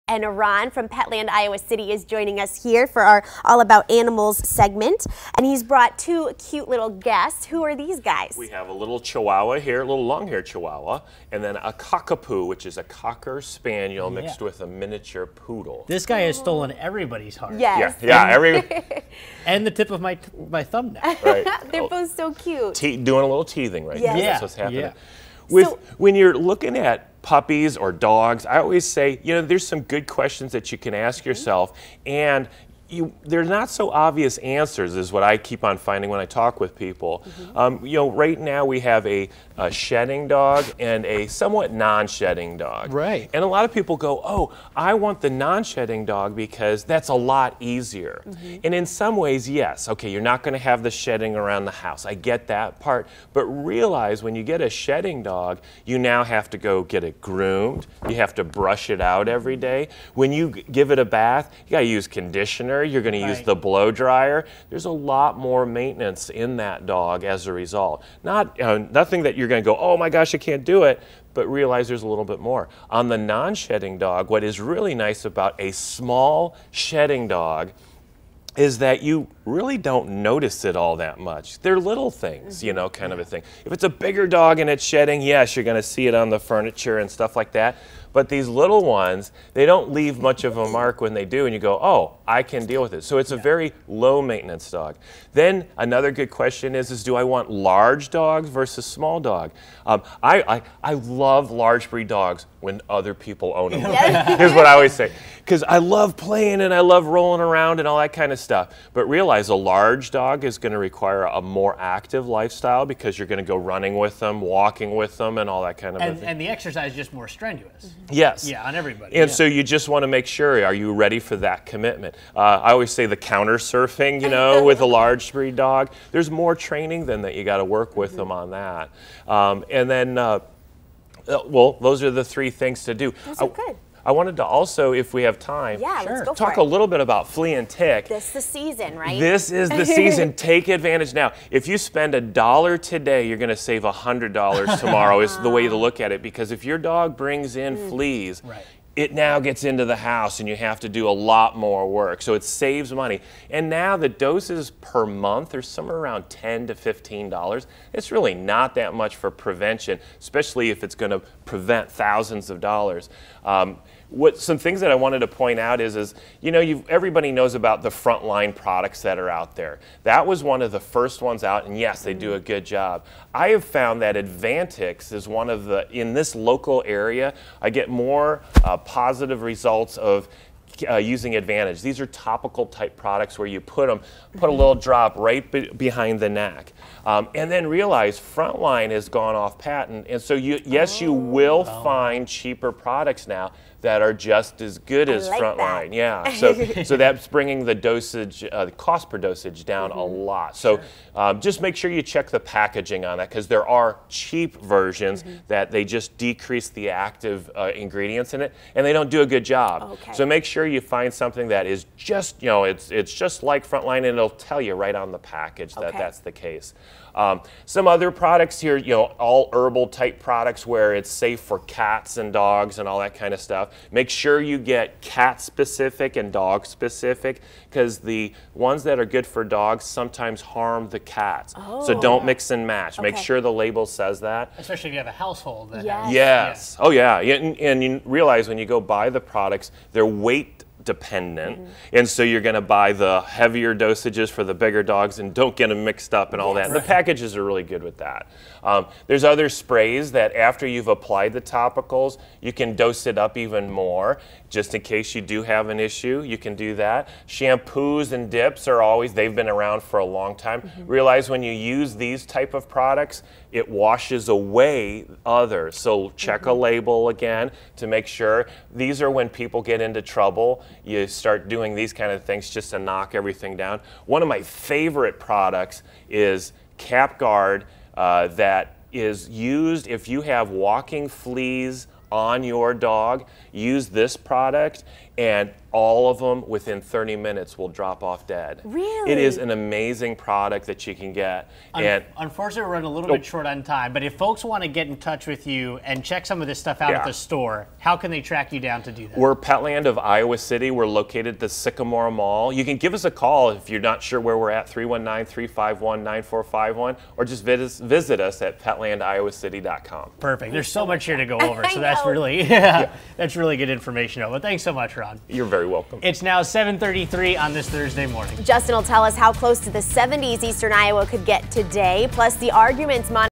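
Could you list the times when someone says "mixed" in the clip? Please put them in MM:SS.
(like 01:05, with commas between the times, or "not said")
00:14, 04:05.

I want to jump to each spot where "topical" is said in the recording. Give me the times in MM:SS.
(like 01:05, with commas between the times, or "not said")
03:02, 04:11.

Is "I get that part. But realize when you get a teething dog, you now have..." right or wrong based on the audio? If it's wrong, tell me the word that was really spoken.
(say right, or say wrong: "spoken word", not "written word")
wrong: "shedding", not "teething".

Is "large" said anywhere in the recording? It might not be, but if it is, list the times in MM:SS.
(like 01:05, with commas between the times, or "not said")
01:37, 01:41, 01:49, 02:04.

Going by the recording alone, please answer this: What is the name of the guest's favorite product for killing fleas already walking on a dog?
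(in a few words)
Capguard.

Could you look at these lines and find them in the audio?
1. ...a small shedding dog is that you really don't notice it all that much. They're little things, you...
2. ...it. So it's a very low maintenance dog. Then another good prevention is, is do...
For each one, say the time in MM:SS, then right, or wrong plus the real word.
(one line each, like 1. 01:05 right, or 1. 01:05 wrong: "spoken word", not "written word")
1. 01:15 right
2. 01:32 wrong: "question", not "prevention".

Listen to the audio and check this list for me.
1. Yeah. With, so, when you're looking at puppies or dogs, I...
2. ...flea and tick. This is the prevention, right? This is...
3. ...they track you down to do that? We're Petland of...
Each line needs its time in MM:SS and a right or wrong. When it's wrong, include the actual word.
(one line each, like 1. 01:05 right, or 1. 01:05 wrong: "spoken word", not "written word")
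1. 00:24 right
2. 02:17 wrong: "season", not "prevention"
3. 04:58 right.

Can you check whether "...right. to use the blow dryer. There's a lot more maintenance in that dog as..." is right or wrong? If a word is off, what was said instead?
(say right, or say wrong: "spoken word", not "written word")
right.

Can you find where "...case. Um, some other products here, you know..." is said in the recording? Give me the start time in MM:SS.
03:36.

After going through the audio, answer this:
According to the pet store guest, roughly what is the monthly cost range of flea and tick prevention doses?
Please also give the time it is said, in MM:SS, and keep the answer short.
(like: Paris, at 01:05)
$10 to $15, at 02:36.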